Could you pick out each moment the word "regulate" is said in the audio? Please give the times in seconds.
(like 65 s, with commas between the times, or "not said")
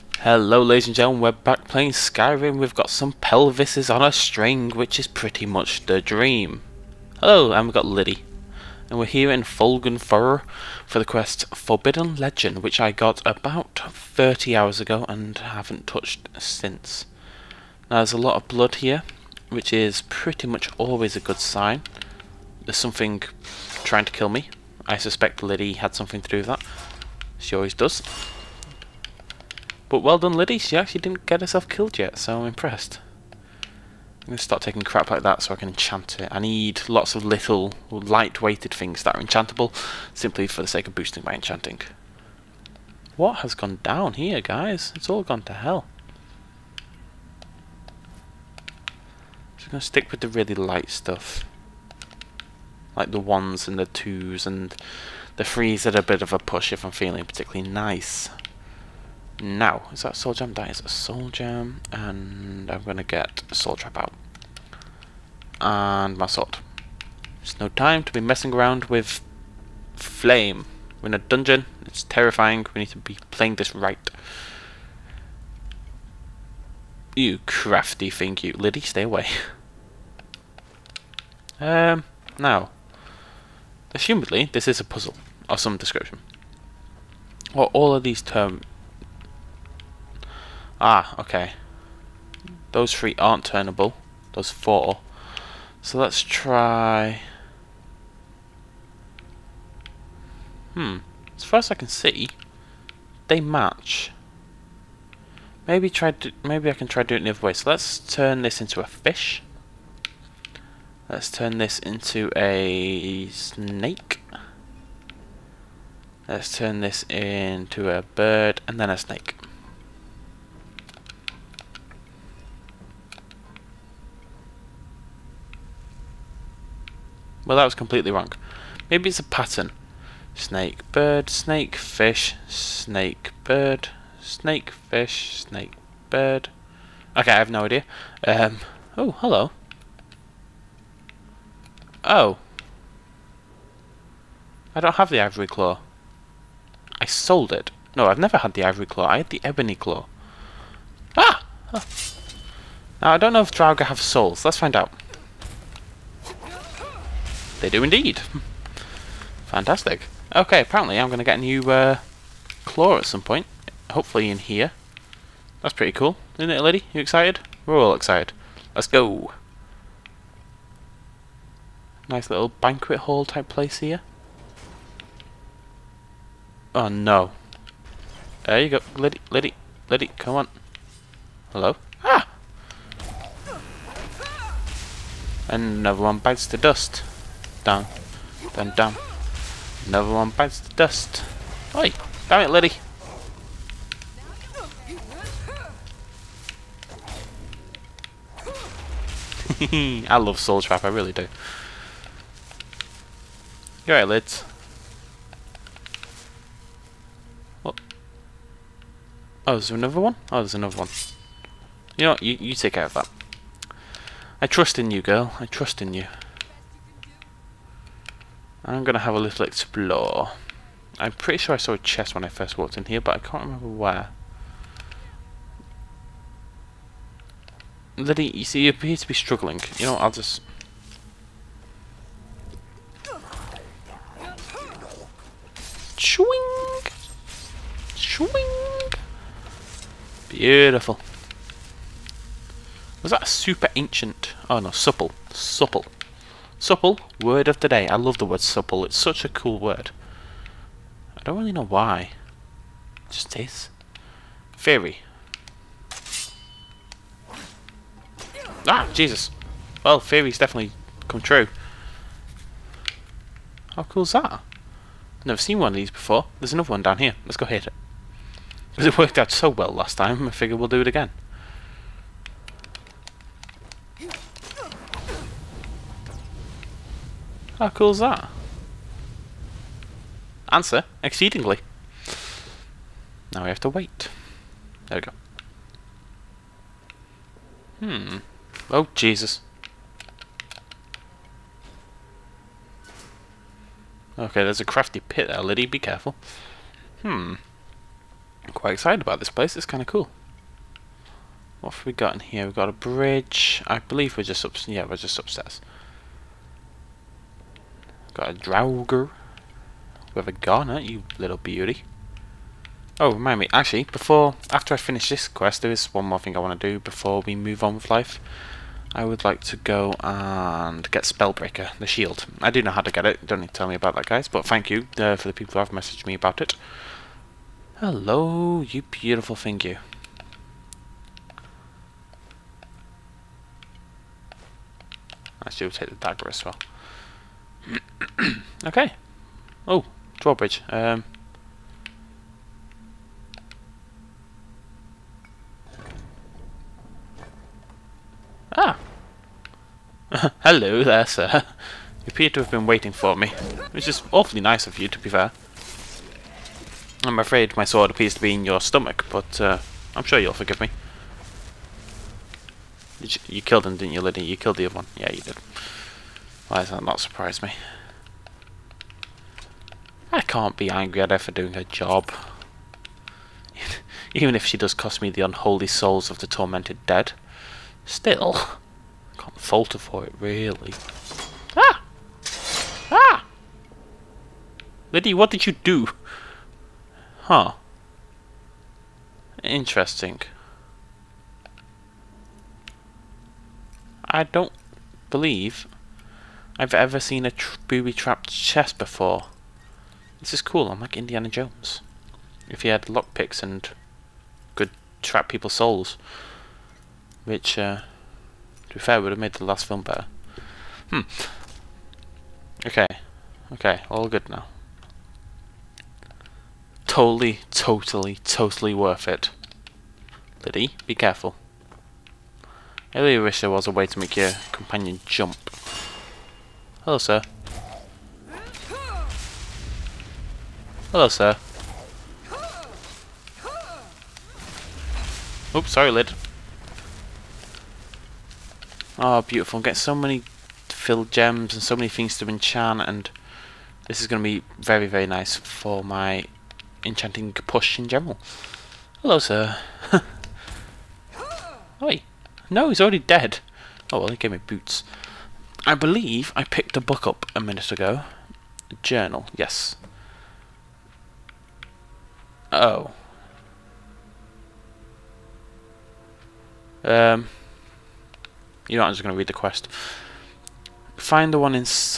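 not said.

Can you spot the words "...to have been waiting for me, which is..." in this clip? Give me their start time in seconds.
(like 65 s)
352 s.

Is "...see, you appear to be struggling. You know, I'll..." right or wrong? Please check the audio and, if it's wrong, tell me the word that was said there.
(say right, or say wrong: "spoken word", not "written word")
right.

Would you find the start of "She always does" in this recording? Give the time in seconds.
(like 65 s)
27 s.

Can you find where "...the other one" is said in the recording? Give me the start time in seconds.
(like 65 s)
364 s.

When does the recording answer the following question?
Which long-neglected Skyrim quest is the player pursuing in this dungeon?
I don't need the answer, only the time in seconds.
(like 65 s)
11 s.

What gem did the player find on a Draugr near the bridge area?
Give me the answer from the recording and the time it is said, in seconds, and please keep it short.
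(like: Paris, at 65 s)
Garnet, at 310 s.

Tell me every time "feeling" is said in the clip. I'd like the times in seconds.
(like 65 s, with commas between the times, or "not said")
56 s.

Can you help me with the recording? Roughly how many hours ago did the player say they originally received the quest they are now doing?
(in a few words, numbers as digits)
30.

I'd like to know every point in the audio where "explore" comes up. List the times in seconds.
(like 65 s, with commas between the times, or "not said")
219 s.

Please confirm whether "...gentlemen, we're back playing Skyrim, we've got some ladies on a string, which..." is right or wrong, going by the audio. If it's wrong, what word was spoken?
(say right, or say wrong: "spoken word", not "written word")
wrong: "pelvises", not "ladies".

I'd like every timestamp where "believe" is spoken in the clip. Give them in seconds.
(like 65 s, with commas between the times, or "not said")
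303 s, 395 s, 455 s.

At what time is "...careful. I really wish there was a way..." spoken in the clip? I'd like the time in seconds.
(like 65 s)
420 s.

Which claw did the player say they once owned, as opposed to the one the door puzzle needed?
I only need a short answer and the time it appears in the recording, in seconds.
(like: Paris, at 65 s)
Ebony claw, at 149 s.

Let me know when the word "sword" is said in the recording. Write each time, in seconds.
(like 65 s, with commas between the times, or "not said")
66 s, 357 s.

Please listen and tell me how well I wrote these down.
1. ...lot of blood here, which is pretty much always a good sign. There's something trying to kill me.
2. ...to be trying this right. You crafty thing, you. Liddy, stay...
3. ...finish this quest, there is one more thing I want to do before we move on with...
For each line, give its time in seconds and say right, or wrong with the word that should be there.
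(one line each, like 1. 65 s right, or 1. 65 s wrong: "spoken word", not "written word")
1. 18 s right
2. 72 s wrong: "playing", not "trying"
3. 314 s right.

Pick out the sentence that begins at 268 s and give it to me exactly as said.
Because it worked out so well last time, I figure we'll do it again.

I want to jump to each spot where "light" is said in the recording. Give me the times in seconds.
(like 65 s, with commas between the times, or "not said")
37 s, 50 s.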